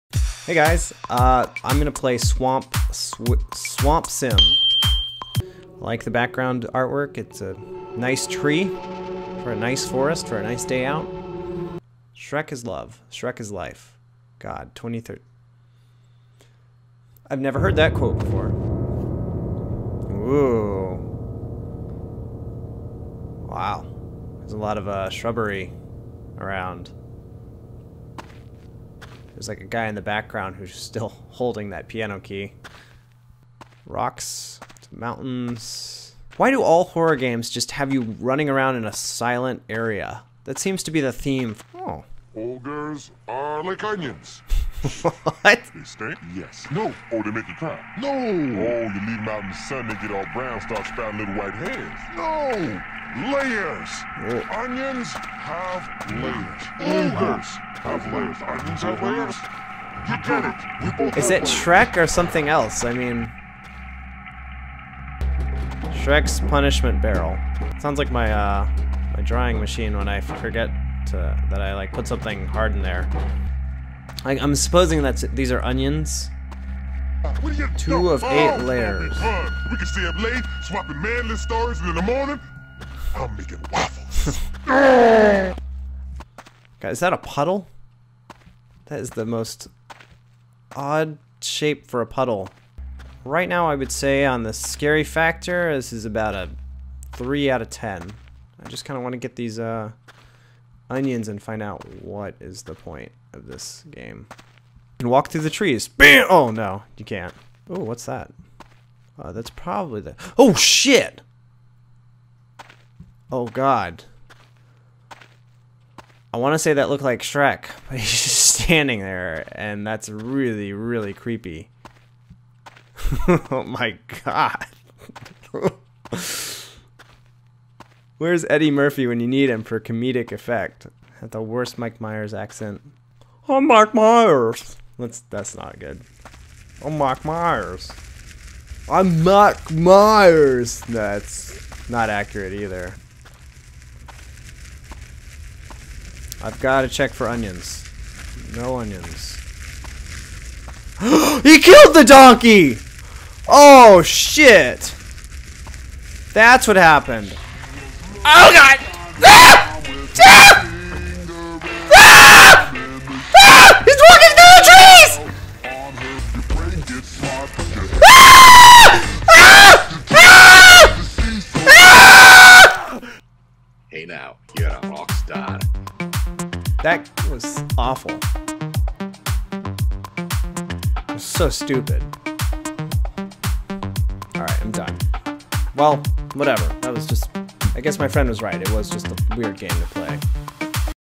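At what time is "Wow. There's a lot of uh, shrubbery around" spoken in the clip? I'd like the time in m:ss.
0:23.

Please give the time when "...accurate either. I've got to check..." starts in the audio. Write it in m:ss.
2:22.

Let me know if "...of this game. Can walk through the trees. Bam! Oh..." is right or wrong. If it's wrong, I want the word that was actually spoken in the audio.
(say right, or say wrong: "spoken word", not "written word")
right.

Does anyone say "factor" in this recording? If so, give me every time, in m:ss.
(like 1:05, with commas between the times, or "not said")
1:35.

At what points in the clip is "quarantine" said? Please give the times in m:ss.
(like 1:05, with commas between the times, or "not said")
not said.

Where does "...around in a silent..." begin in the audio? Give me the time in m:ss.
0:38.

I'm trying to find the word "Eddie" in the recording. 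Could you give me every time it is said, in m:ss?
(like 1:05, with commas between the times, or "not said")
2:08.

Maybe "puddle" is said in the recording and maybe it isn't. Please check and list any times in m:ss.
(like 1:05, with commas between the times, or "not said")
1:27, 1:32.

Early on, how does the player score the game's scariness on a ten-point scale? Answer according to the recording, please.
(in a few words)
3.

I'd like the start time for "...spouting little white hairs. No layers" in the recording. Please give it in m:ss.
0:50.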